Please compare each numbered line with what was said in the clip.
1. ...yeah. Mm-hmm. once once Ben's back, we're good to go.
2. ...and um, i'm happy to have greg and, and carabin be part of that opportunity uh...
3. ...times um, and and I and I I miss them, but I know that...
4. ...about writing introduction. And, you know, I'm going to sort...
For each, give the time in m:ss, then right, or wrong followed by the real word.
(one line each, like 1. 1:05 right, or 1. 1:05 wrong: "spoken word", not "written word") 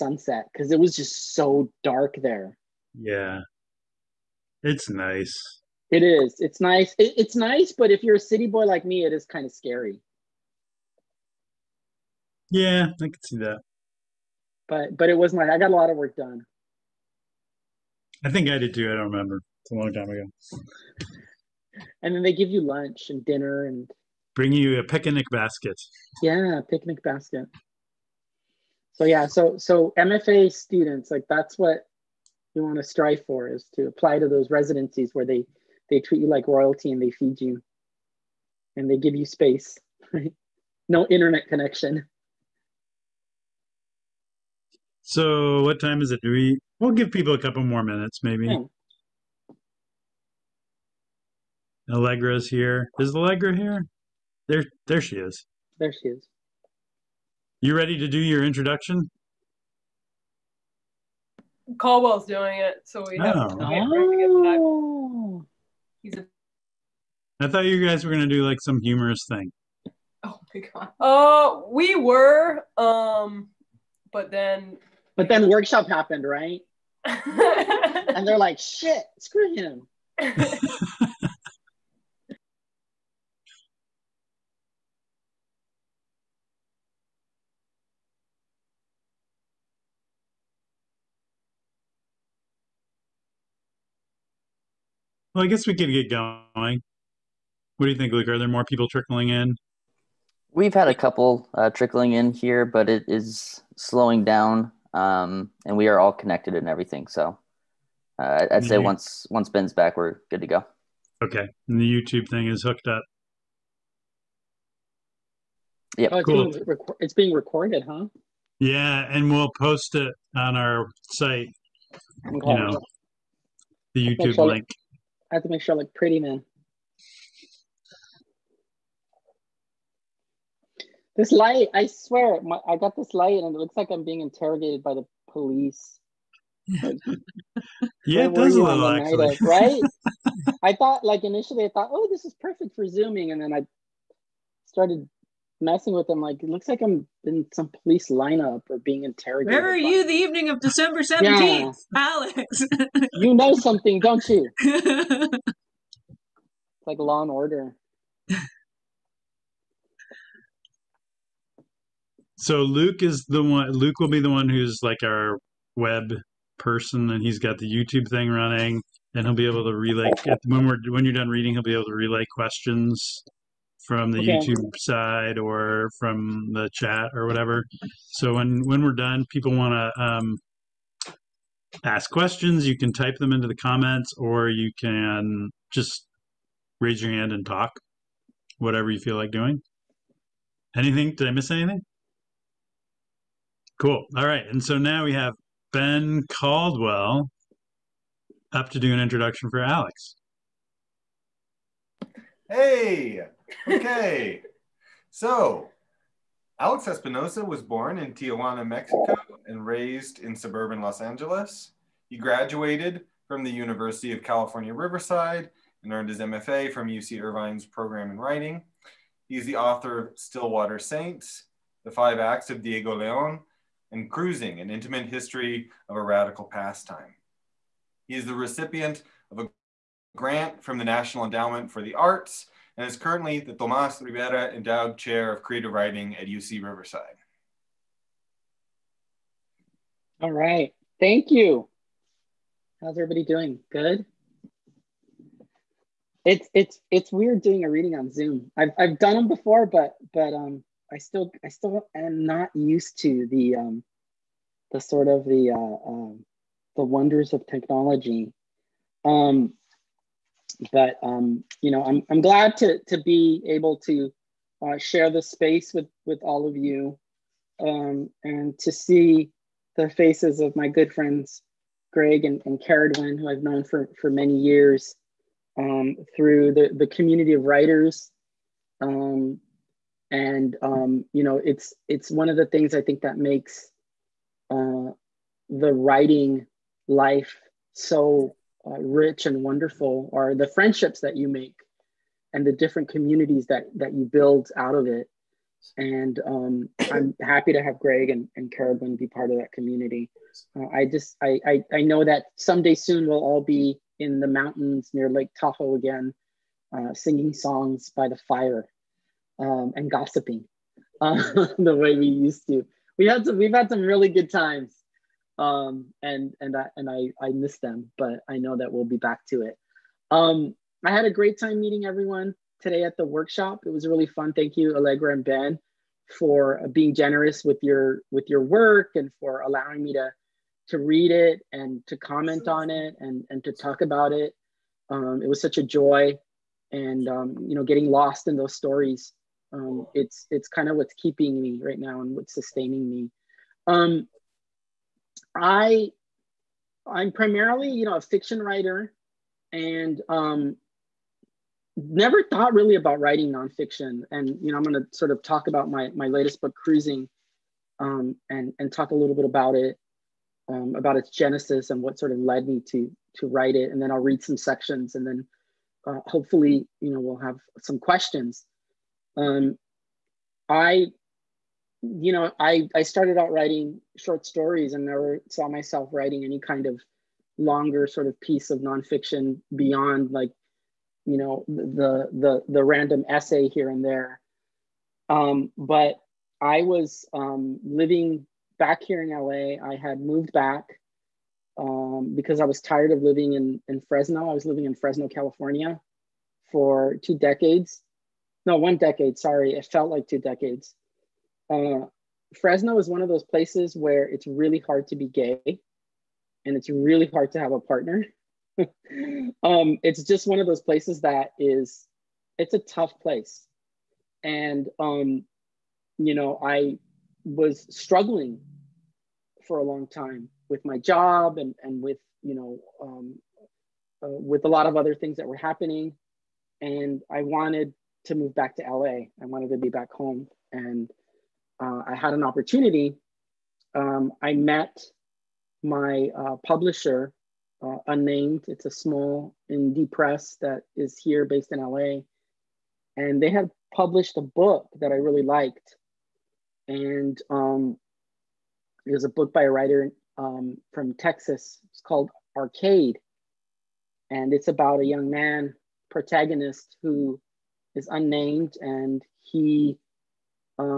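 1. 1:48 right
2. 4:55 wrong: "community", not "opportunity"
3. 5:14 right
4. 5:52 wrong: "nonfiction", not "introduction".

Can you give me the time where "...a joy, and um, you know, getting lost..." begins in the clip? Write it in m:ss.
5:35.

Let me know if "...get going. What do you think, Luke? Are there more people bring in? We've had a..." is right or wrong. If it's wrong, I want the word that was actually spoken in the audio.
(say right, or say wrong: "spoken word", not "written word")
wrong: "trickling", not "bring".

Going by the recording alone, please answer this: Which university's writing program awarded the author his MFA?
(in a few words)
UC Irvine.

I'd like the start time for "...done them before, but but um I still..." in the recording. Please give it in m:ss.
4:08.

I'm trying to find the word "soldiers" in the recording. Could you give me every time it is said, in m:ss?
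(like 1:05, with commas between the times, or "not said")
not said.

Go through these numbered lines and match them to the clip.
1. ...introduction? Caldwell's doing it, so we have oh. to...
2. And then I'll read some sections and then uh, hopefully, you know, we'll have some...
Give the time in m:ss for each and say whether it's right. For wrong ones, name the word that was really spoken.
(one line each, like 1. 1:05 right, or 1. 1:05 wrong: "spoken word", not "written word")
1. 0:58 right
2. 6:03 right.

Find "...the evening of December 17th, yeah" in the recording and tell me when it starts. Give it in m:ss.
2:30.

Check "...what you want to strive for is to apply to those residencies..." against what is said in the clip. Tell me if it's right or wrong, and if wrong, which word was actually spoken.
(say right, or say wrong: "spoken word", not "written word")
right.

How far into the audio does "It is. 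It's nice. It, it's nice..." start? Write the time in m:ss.
0:05.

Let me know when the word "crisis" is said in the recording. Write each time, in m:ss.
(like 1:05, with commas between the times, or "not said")
not said.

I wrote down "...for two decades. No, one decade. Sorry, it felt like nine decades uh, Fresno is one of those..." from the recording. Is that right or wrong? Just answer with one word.
wrong.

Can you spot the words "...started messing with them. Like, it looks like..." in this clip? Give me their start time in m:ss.
2:24.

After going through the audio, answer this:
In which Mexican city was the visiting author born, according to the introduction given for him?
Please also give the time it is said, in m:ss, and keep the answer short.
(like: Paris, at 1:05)
Tijuana, at 3:28.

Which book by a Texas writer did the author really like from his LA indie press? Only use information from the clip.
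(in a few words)
Arcade.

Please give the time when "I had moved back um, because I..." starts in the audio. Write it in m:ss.
6:29.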